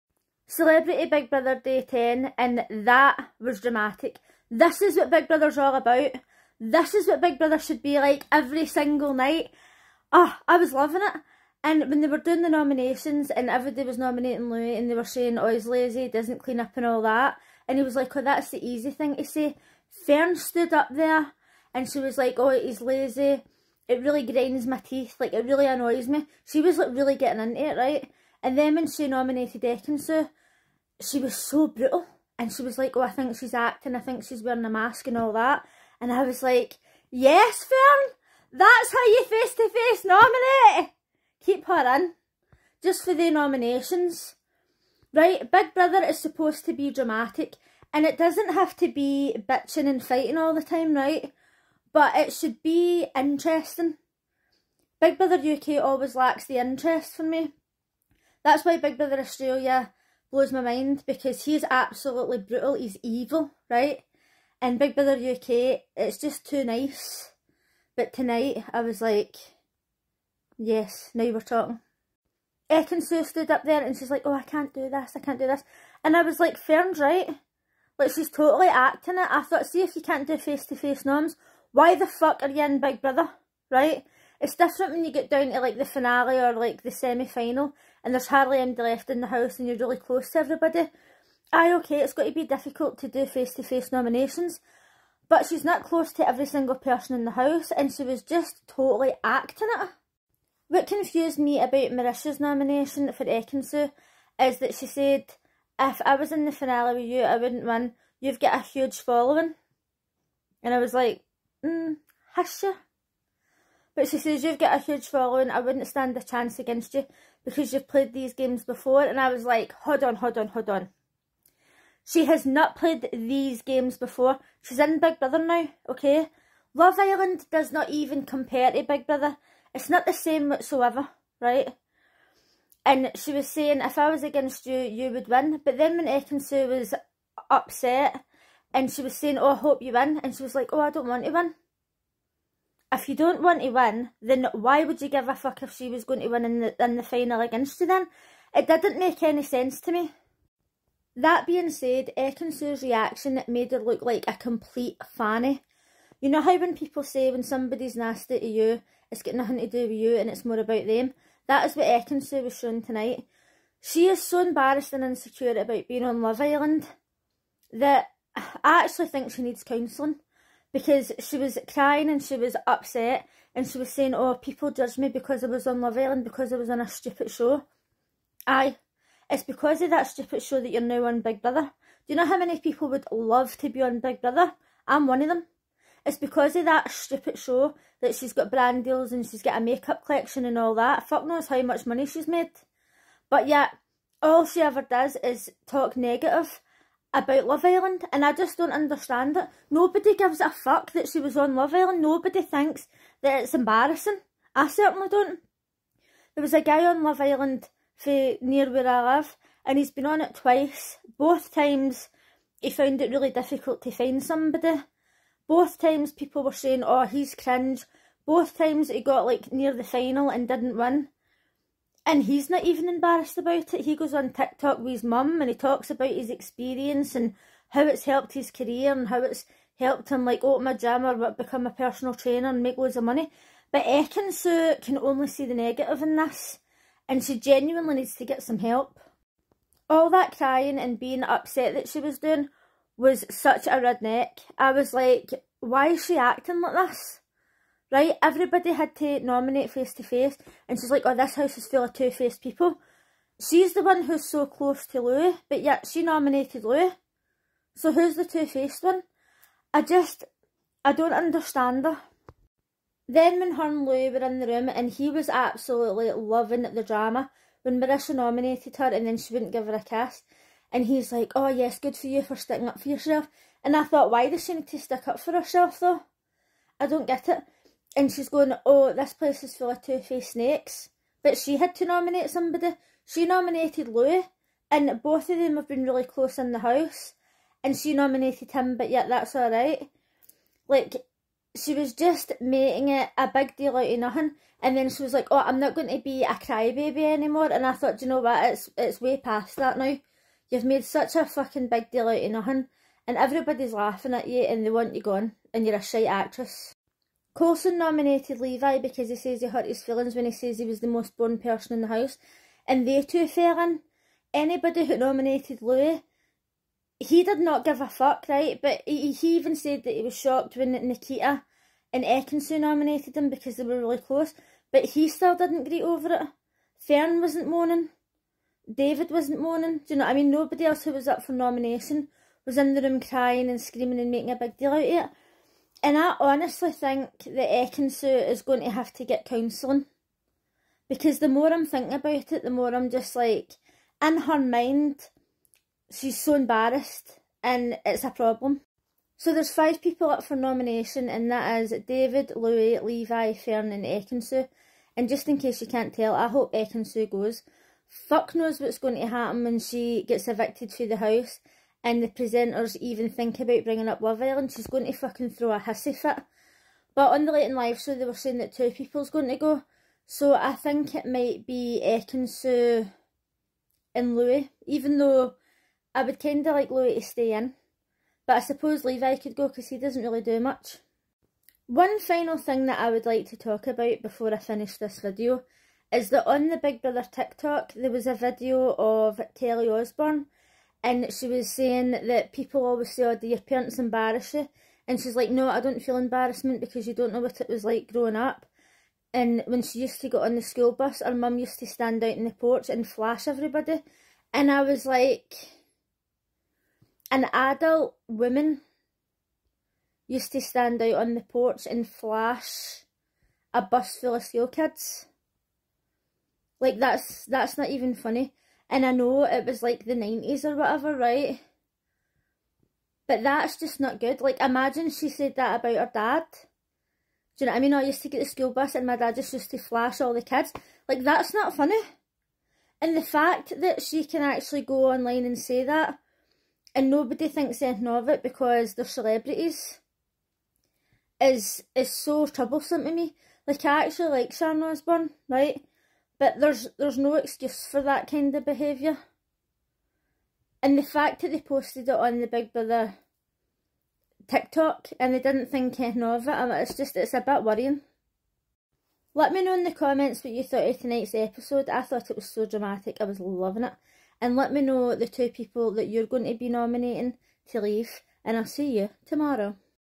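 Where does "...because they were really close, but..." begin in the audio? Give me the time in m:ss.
5:23.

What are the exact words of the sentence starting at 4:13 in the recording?
She's the one who's so close to Louis, but yet she nominated Louis.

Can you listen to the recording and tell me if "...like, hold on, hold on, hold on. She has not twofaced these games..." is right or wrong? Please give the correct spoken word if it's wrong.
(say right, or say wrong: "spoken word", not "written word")
wrong: "played", not "twofaced".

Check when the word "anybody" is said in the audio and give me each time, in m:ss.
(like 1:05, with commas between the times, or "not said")
1:28, 5:14.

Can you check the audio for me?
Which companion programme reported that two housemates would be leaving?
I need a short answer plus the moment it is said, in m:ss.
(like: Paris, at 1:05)
Late and Live, at 6:07.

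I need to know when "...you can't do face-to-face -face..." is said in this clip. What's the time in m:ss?
1:19.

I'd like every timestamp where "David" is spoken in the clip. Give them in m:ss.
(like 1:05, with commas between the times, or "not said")
5:28, 5:51.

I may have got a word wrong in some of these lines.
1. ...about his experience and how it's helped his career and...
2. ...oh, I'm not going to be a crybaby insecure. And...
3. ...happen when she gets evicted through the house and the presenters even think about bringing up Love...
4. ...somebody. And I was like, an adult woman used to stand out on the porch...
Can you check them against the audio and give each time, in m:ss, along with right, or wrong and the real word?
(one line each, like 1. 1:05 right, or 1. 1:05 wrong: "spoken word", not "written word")
1. 3:45 right
2. 4:55 wrong: "anymore", not "insecure"
3. 5:59 right
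4. 6:43 wrong: "everybody", not "somebody".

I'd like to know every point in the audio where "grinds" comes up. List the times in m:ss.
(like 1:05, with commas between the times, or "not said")
0:24.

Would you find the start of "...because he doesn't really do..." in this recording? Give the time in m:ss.
6:19.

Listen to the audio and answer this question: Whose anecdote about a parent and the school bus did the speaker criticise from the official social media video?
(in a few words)
Kelly Osbourne.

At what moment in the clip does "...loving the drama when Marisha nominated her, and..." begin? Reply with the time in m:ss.
4:26.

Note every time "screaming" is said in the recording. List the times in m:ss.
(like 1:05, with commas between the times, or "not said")
5:33.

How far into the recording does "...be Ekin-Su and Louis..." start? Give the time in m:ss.
6:11.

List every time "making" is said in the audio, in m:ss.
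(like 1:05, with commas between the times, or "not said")
4:52, 5:34.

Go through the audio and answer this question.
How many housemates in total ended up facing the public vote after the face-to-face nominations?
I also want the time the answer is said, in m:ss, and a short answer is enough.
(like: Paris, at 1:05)
5, at 5:49.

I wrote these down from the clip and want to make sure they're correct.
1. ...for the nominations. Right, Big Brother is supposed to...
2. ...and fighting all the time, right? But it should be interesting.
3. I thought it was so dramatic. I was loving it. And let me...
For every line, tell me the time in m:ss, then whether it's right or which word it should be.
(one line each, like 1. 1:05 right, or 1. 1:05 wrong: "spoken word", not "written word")
1. 0:43 right
2. 0:49 right
3. 7:41 right.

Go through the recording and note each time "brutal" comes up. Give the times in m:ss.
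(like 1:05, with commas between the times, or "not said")
0:31, 1:02.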